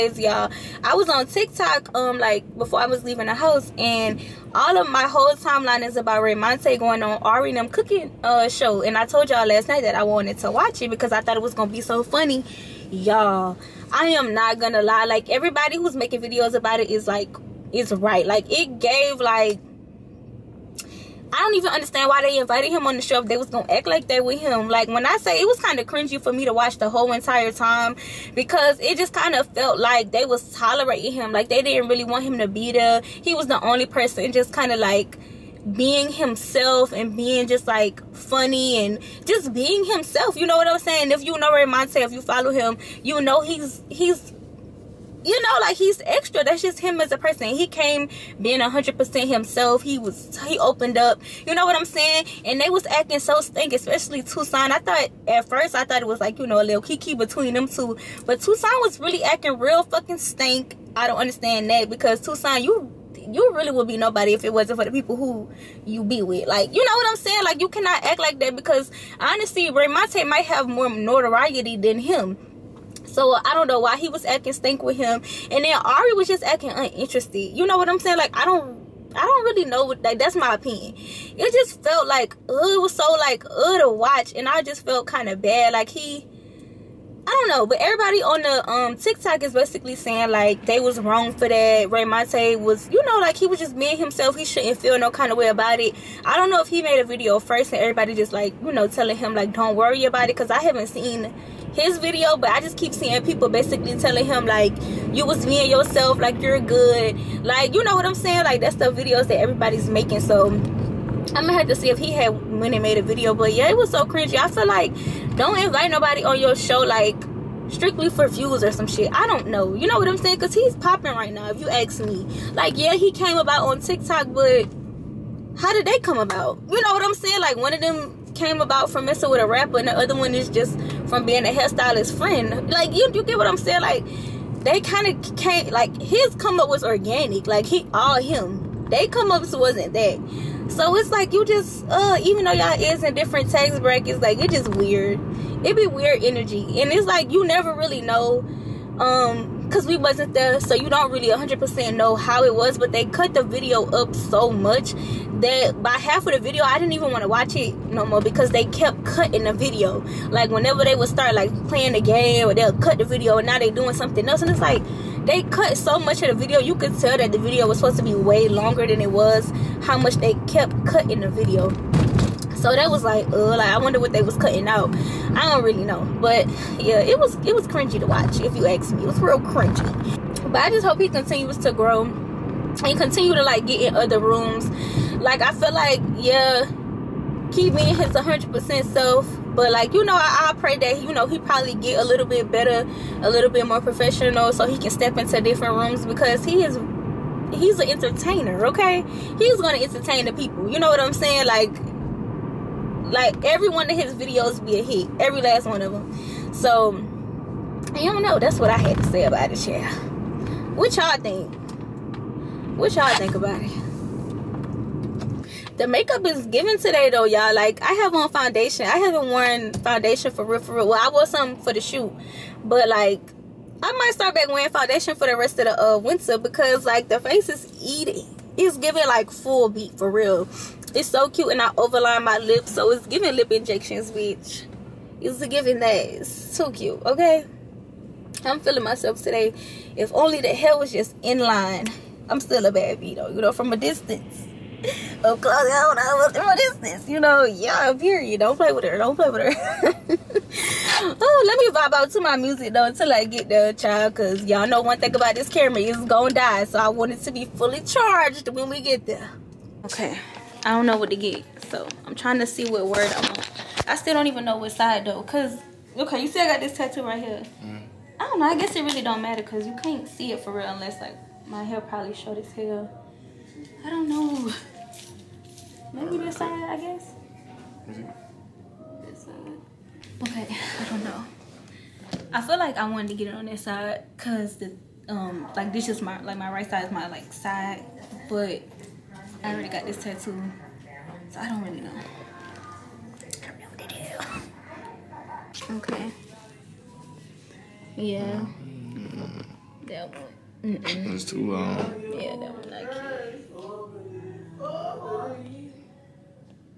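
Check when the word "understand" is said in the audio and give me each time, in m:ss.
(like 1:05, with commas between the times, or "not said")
0:21, 1:01.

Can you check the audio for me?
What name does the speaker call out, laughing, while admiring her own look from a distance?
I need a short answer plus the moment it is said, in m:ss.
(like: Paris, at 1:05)
Claudia, at 4:05.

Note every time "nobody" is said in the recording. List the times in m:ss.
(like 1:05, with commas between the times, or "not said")
1:03, 1:55.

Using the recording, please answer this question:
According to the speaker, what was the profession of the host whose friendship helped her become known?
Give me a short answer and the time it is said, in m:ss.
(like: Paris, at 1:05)
Hairstylist, at 2:11.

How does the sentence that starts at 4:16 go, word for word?
So I want it to be fully charged when we get there.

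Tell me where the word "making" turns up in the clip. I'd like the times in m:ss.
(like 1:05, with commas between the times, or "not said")
0:15, 1:49.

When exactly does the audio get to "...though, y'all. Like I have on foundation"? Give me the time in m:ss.
3:37.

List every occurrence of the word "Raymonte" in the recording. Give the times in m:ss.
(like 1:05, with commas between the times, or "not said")
0:06, 1:09, 1:31.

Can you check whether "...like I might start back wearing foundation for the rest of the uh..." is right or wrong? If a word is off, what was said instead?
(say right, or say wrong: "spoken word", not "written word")
right.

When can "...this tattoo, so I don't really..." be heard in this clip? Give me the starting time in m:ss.
4:49.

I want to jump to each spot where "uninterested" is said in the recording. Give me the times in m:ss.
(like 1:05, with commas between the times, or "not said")
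1:16.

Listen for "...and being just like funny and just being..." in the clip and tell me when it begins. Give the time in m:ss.
0:36.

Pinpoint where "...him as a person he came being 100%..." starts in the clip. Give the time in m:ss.
0:46.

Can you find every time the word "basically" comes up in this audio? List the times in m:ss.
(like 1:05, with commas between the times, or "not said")
1:29, 1:43.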